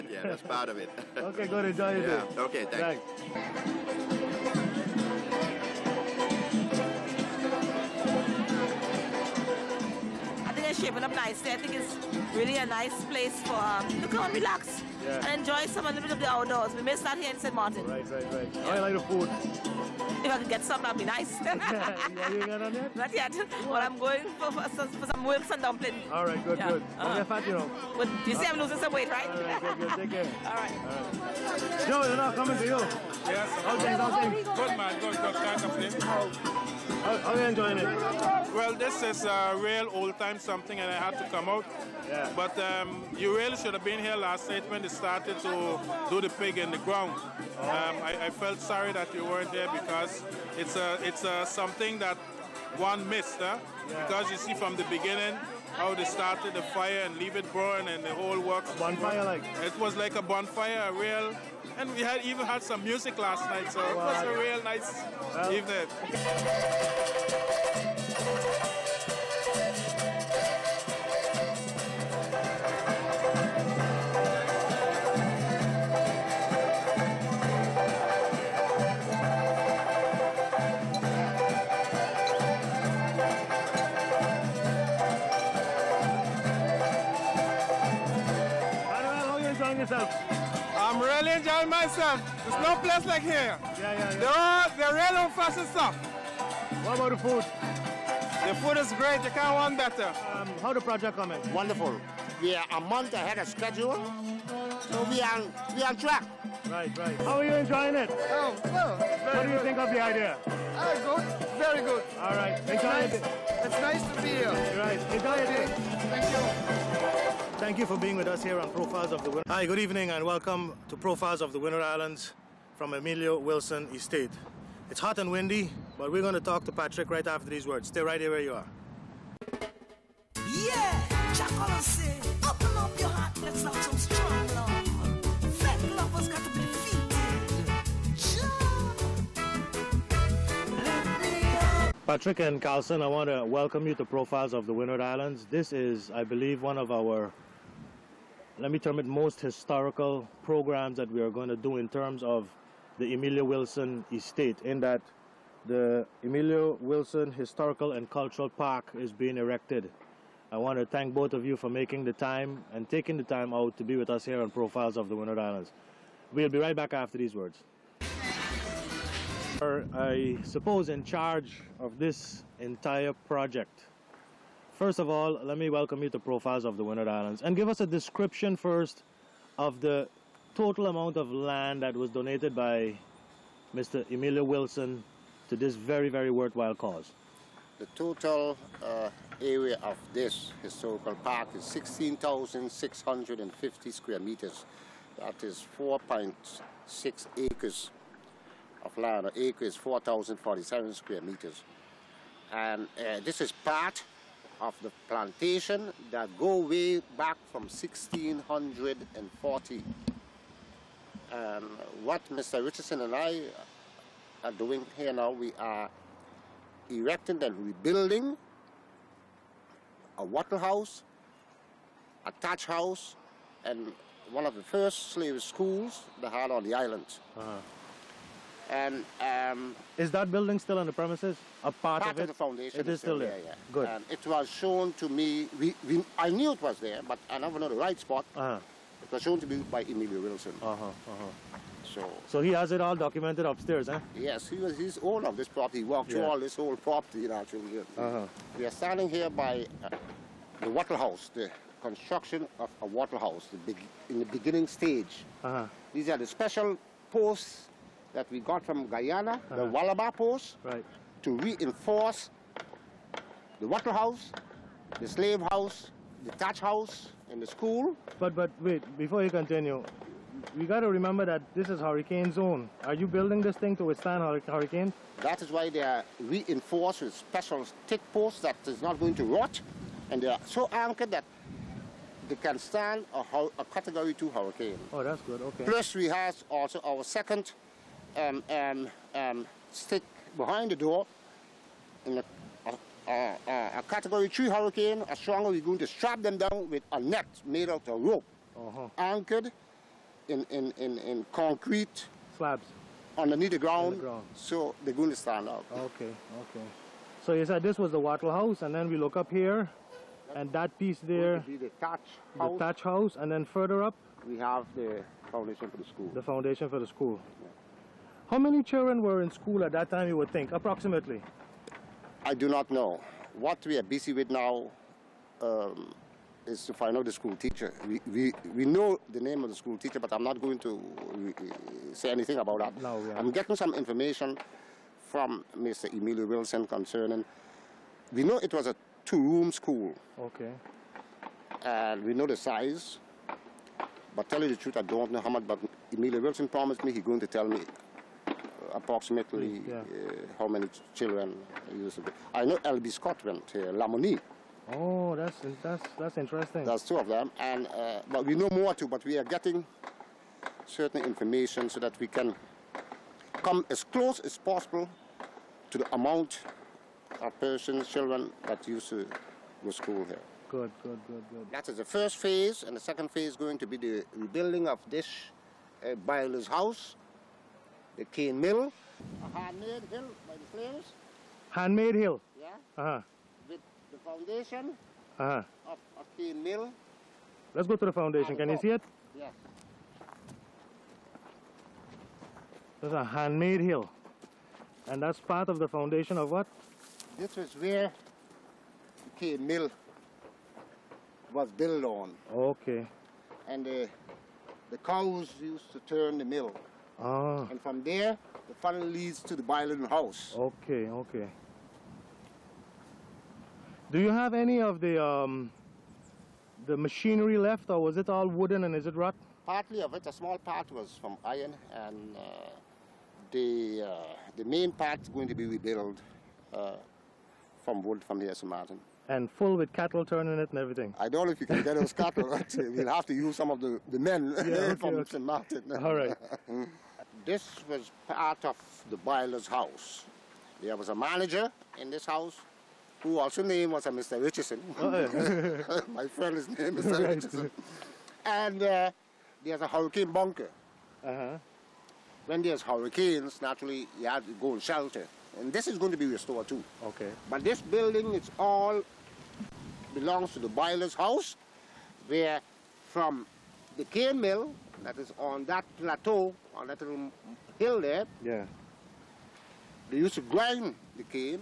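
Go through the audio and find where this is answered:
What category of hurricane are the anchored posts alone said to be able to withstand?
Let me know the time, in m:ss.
4:43.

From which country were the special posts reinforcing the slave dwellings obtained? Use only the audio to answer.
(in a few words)
Guyana.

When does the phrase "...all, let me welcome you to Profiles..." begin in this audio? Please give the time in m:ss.
2:55.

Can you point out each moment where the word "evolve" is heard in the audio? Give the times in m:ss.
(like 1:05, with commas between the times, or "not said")
not said.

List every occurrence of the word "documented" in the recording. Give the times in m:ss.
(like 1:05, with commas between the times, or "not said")
4:02.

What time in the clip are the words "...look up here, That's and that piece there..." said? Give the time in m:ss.
5:08.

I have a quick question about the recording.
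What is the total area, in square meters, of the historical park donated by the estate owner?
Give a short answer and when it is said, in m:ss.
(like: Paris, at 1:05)
16,650, at 3:11.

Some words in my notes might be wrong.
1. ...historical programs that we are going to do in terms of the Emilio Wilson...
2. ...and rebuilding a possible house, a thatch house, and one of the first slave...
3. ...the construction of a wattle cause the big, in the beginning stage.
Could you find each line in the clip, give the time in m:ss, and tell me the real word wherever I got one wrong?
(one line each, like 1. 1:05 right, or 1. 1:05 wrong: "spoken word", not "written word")
1. 2:29 right
2. 3:37 wrong: "wattle", not "possible"
3. 4:11 wrong: "house", not "cause".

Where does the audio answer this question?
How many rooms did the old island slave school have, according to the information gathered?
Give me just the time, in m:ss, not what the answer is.
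5:39.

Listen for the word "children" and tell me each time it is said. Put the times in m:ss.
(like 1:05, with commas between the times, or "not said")
5:18, 5:50, 6:07.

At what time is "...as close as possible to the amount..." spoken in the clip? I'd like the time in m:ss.
6:03.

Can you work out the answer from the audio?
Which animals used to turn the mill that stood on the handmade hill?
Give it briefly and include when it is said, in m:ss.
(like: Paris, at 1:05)
Cows, at 6:44.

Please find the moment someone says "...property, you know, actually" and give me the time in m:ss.
4:06.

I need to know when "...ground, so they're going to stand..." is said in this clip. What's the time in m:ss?
5:03.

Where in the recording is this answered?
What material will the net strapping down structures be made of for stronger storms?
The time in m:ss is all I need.
4:57.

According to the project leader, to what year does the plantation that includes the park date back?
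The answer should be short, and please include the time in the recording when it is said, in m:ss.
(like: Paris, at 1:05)
1640, at 3:27.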